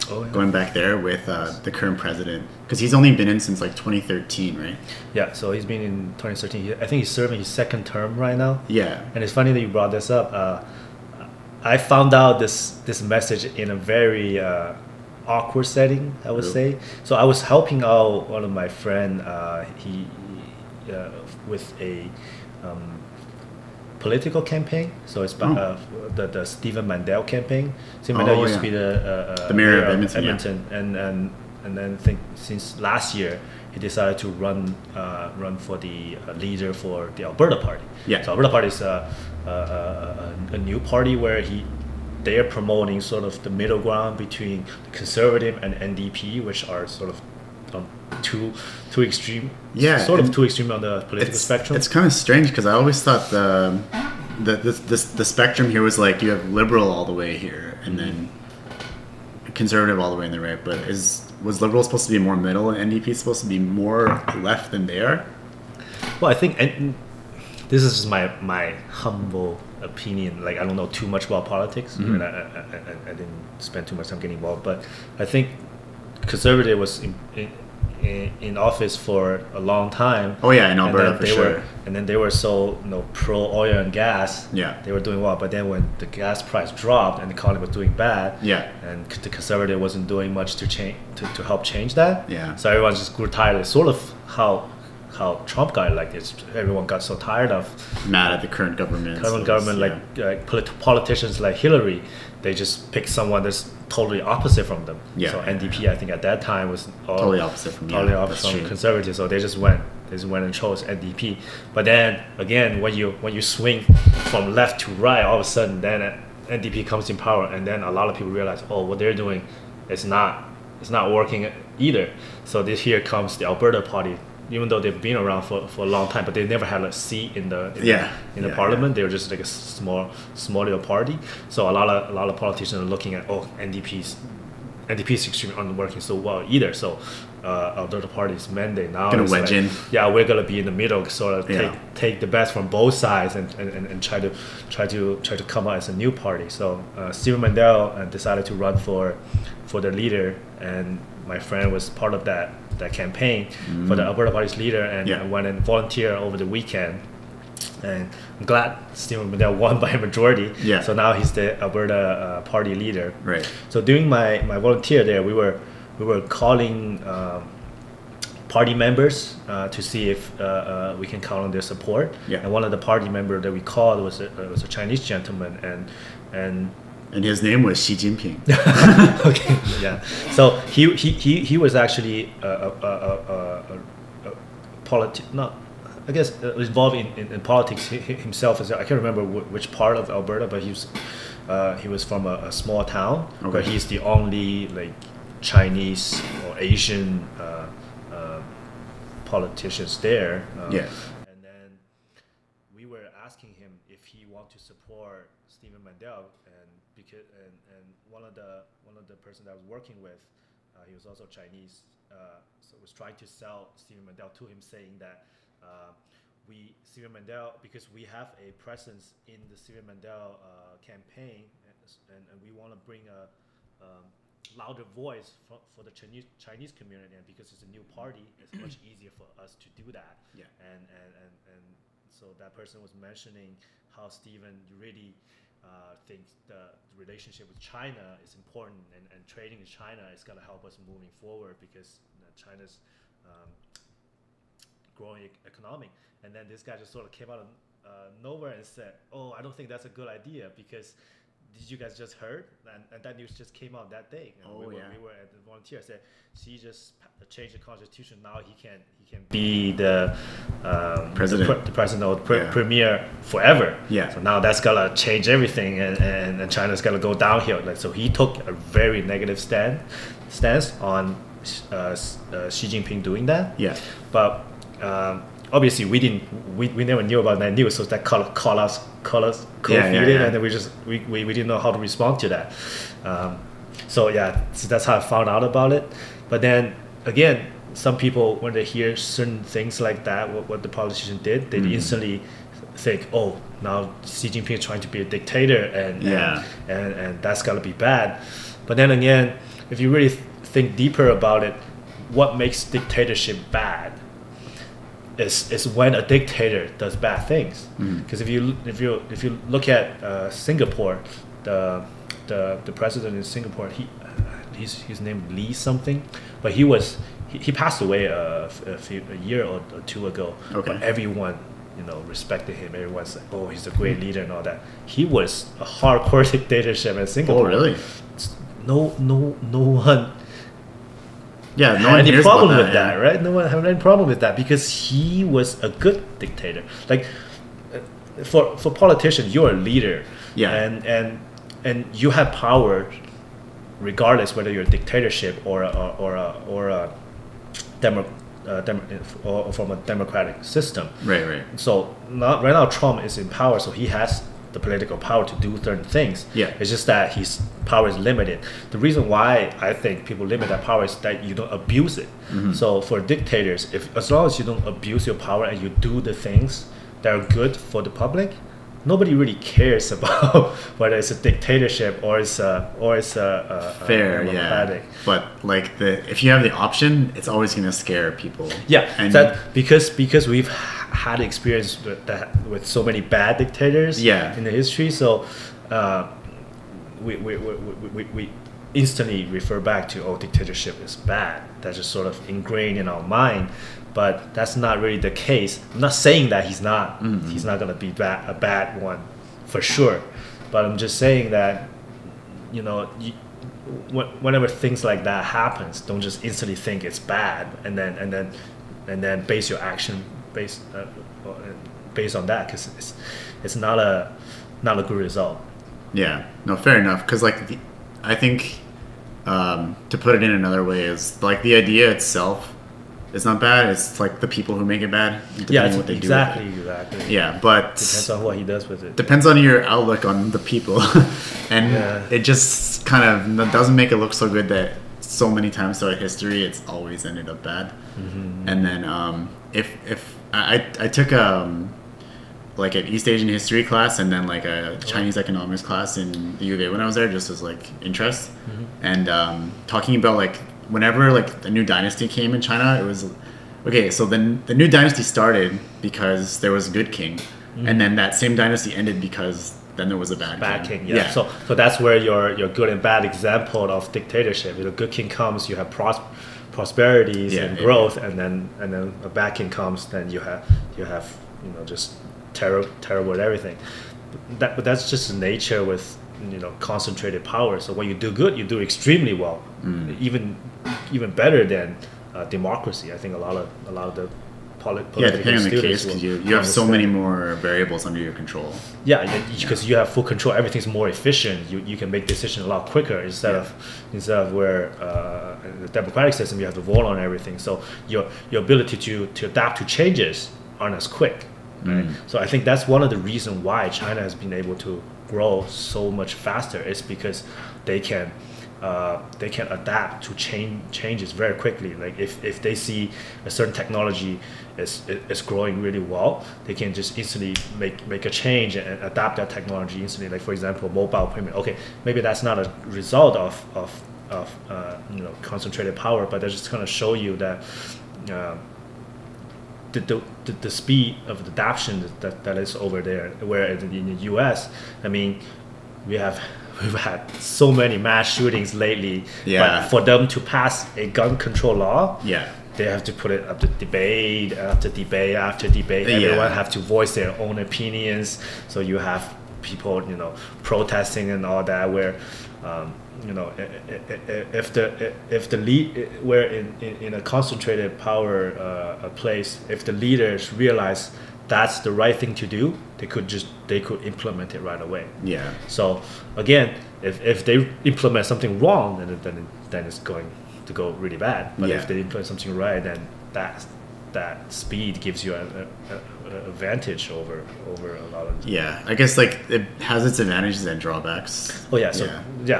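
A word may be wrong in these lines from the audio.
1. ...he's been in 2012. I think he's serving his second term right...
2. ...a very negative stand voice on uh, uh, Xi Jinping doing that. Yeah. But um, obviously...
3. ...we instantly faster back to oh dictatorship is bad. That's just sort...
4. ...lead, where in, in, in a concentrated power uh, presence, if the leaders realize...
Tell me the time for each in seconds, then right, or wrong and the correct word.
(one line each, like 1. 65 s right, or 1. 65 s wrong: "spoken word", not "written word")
1. 5 s wrong: "2013", not "2012"
2. 268 s wrong: "stance", not "voice"
3. 388 s wrong: "refer", not "faster"
4. 555 s wrong: "place", not "presence".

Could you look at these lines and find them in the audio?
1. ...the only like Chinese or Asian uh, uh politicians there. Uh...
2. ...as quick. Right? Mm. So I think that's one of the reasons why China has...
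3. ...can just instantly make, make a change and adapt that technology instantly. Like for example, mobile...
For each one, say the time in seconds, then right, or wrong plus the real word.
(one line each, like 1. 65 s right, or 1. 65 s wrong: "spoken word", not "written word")
1. 193 s right
2. 500 s right
3. 516 s right.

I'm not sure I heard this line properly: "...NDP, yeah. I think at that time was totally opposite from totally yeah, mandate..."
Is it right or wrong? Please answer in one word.
wrong.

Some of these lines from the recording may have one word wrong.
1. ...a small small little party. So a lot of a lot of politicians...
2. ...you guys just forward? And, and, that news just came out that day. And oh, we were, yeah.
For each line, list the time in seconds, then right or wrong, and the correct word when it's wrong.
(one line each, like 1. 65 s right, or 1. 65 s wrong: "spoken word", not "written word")
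1. 129 s right
2. 251 s wrong: "heard", not "forward".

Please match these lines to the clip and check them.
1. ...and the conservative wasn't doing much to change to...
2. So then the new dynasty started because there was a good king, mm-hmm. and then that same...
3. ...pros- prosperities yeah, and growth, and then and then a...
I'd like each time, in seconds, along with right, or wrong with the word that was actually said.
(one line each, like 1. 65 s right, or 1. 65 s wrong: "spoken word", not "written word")
1. 88 s right
2. 453 s right
3. 465 s right.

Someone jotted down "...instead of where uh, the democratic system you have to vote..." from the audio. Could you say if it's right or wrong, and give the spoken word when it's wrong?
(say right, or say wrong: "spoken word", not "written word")
right.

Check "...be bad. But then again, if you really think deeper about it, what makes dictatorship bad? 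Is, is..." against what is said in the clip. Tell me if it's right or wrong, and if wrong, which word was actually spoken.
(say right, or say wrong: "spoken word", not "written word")
right.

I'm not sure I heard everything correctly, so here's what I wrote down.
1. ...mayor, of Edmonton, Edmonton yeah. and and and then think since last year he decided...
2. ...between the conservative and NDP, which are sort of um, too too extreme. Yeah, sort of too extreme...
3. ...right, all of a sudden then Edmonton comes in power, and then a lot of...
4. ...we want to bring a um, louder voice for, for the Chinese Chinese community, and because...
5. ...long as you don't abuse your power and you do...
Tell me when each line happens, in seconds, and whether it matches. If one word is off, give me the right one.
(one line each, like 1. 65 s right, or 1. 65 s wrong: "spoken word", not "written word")
1. 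29 s right
2. 44 s right
3. 114 s wrong: "NDP", not "Edmonton"
4. 222 s right
5. 364 s right.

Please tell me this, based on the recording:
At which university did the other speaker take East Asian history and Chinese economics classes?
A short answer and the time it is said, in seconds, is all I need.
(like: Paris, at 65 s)
U of A, at 446 s.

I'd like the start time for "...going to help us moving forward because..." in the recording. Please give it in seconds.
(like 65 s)
240 s.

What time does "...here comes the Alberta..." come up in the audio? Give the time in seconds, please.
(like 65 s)
122 s.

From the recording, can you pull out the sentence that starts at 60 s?
But is was liberal supposed to be more middle, and NDP supposed to be more left than they are?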